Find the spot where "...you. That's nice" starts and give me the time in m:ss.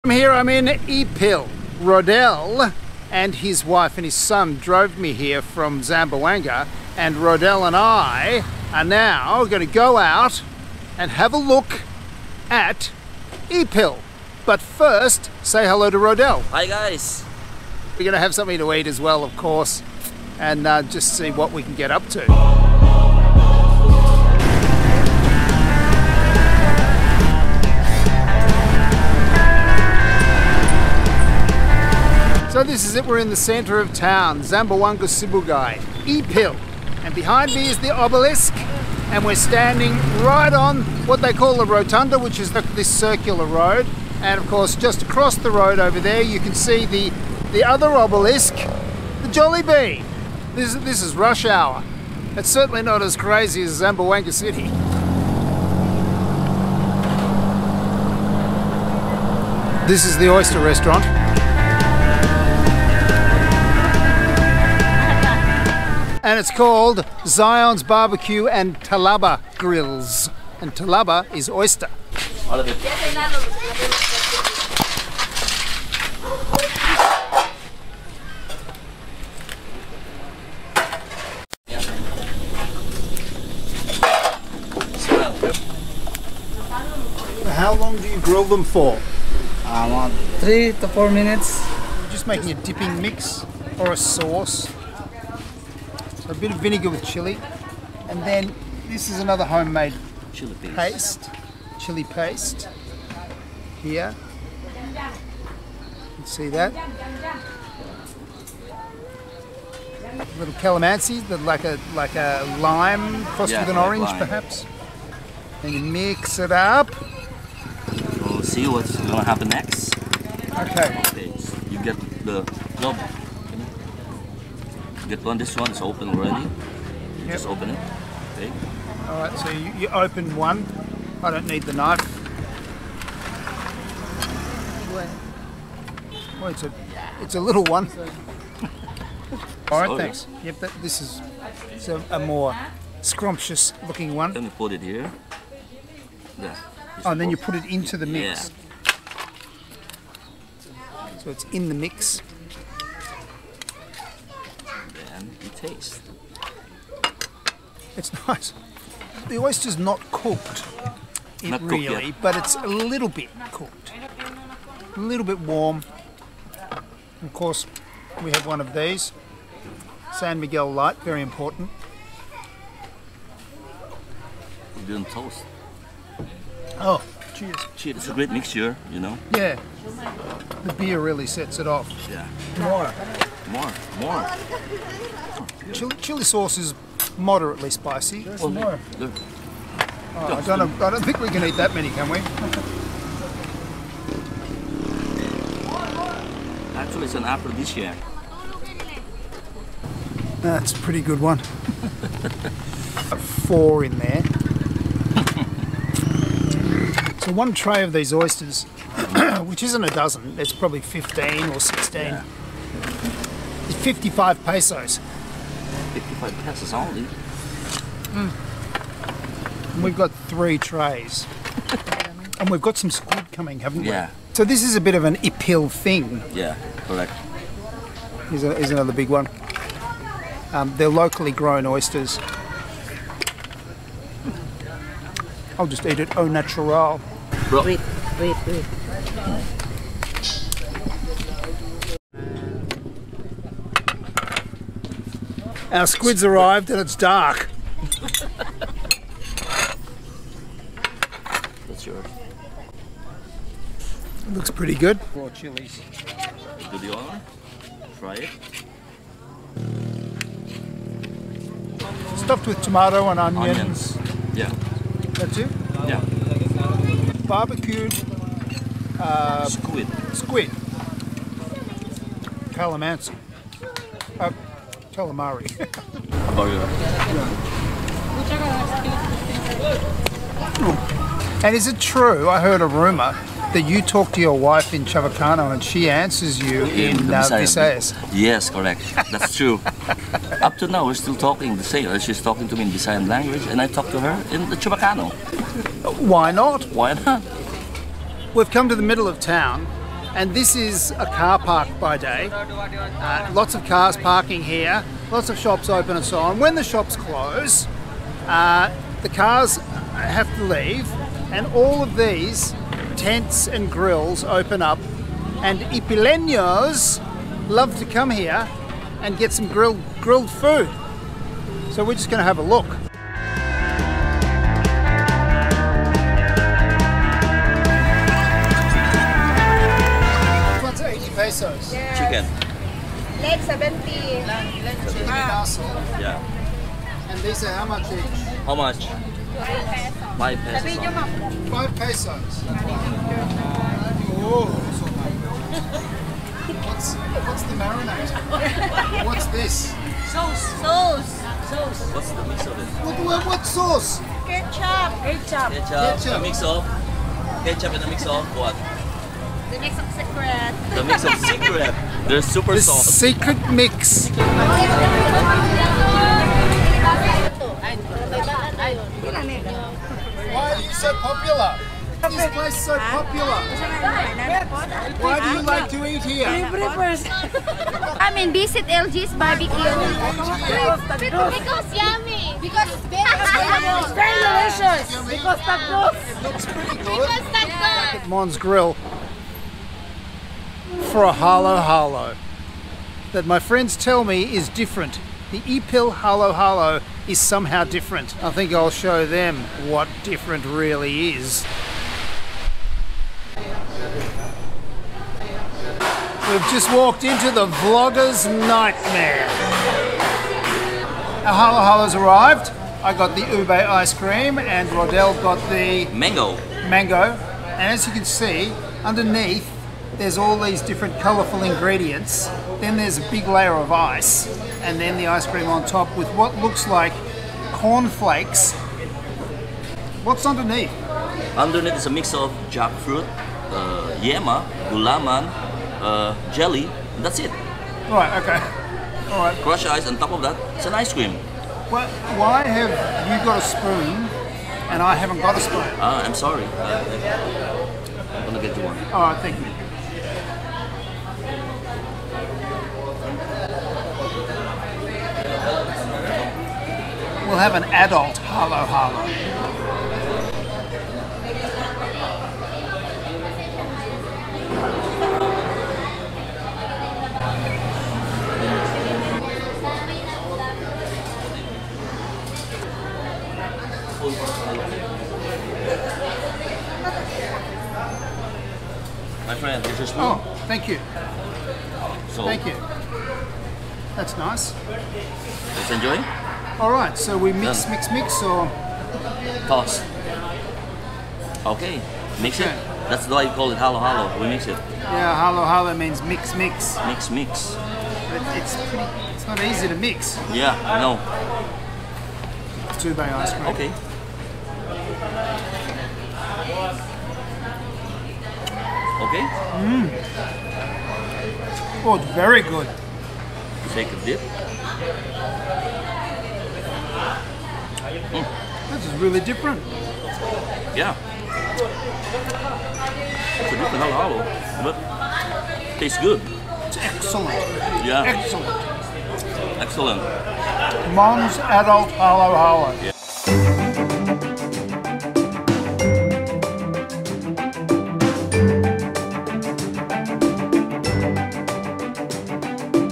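8:02.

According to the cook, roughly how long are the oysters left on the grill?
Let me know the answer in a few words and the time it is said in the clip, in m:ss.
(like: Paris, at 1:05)
3 to 4 minutes, at 1:30.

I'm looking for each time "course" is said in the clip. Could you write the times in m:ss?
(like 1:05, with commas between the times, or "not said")
0:19, 0:44, 2:47.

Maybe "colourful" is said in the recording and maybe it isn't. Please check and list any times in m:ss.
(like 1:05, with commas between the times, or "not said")
7:00.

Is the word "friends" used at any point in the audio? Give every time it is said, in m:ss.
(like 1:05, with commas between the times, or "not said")
6:33, 7:59.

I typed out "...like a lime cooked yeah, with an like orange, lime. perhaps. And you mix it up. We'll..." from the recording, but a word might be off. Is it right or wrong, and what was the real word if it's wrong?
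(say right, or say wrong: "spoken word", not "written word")
wrong: "crossed", not "cooked".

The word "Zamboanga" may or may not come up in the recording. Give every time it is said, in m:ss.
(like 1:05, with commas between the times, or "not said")
0:05, 0:34, 0:53.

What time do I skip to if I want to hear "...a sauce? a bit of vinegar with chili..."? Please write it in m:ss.
1:33.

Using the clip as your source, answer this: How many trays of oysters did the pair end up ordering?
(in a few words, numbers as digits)
3.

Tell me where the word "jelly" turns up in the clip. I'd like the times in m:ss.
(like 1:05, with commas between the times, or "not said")
7:16.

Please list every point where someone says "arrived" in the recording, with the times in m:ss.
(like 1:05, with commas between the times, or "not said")
4:06, 6:51.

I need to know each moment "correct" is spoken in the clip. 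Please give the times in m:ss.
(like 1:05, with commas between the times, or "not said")
3:46, 4:48.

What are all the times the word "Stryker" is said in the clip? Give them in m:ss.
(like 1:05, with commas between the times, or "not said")
not said.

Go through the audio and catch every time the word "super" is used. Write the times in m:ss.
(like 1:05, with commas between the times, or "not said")
6:02.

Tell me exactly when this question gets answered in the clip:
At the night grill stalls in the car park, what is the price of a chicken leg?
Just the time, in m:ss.
5:33.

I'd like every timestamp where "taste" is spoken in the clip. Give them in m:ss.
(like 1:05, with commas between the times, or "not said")
2:35, 8:45.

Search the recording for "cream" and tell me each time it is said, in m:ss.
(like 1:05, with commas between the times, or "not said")
6:53, 7:05, 7:20, 8:23.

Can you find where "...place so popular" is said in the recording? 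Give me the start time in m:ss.
6:12.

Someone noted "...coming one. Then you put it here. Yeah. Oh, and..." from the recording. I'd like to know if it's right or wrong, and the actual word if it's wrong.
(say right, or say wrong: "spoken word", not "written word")
wrong: "looking", not "coming".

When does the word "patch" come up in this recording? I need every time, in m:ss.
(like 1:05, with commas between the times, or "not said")
not said.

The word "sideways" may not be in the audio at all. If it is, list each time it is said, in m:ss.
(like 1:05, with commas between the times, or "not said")
not said.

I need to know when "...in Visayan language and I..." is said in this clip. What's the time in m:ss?
4:52.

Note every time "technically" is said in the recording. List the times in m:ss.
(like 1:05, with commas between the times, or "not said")
not said.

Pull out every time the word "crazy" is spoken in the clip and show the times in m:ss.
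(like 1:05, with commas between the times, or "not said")
0:53.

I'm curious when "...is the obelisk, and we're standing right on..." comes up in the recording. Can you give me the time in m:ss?
0:37.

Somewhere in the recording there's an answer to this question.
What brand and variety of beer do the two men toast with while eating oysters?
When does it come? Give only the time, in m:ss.
2:50.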